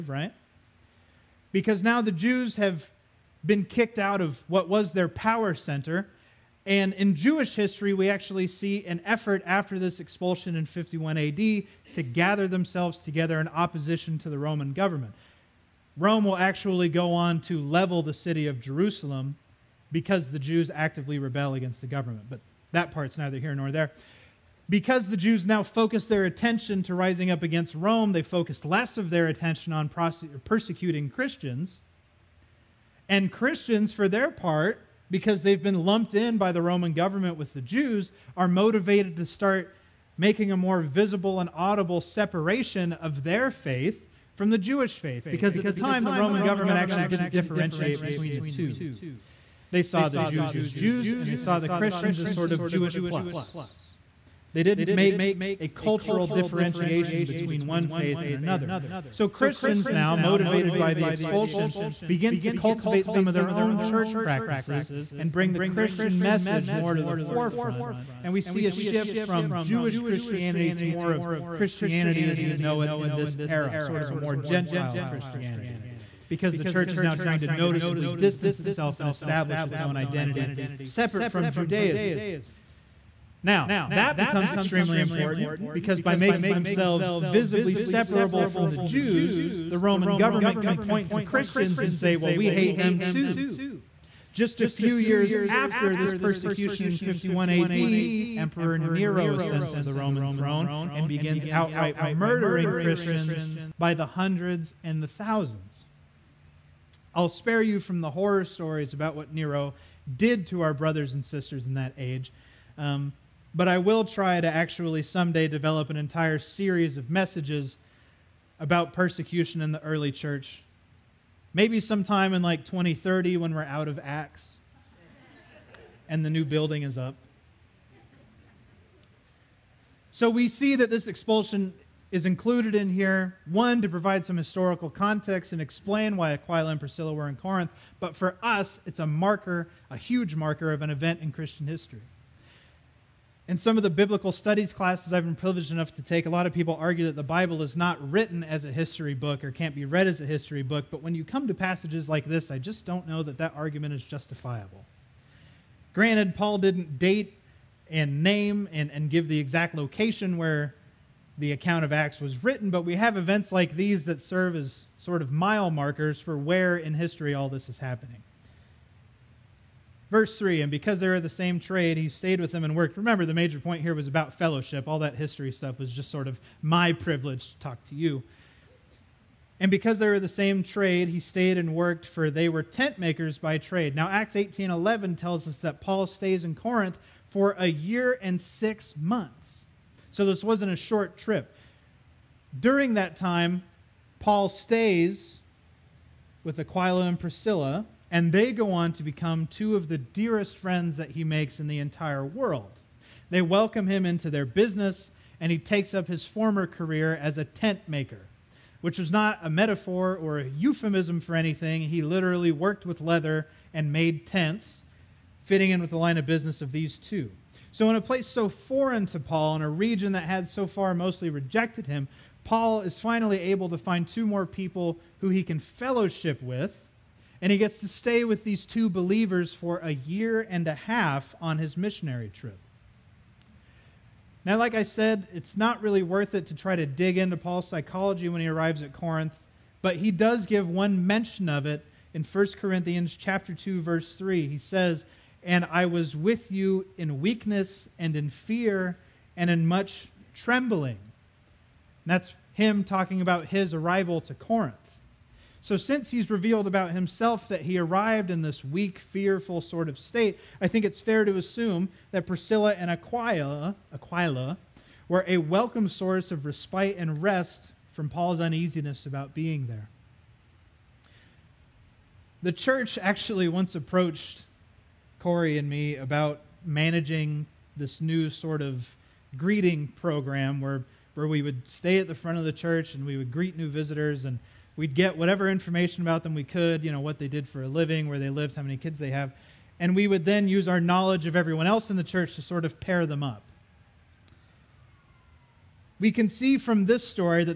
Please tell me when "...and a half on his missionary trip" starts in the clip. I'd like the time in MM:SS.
03:50.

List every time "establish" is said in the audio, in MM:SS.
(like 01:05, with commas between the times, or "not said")
01:19.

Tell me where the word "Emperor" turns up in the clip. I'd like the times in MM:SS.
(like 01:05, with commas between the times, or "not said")
01:38.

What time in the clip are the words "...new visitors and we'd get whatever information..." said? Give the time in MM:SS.
04:43.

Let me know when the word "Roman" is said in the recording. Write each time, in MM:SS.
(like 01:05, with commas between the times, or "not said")
00:14, 00:36, 00:46, 01:29, 01:39.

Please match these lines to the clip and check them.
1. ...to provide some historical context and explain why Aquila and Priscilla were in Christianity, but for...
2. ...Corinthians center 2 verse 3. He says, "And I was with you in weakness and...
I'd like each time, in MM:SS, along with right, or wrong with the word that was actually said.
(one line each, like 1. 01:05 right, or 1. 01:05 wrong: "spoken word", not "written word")
1. 02:13 wrong: "Corinth", not "Christianity"
2. 04:02 wrong: "chapter", not "center".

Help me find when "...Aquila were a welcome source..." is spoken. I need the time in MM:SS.
04:23.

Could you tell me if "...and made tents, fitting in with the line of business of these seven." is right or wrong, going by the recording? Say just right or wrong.
wrong.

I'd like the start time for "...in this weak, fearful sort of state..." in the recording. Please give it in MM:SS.
04:18.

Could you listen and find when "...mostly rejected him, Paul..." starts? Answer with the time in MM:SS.
03:40.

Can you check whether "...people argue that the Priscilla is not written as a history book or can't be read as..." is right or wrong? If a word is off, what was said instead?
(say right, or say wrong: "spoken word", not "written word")
wrong: "Bible", not "Priscilla".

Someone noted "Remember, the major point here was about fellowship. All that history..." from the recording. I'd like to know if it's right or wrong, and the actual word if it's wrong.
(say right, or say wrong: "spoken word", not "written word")
right.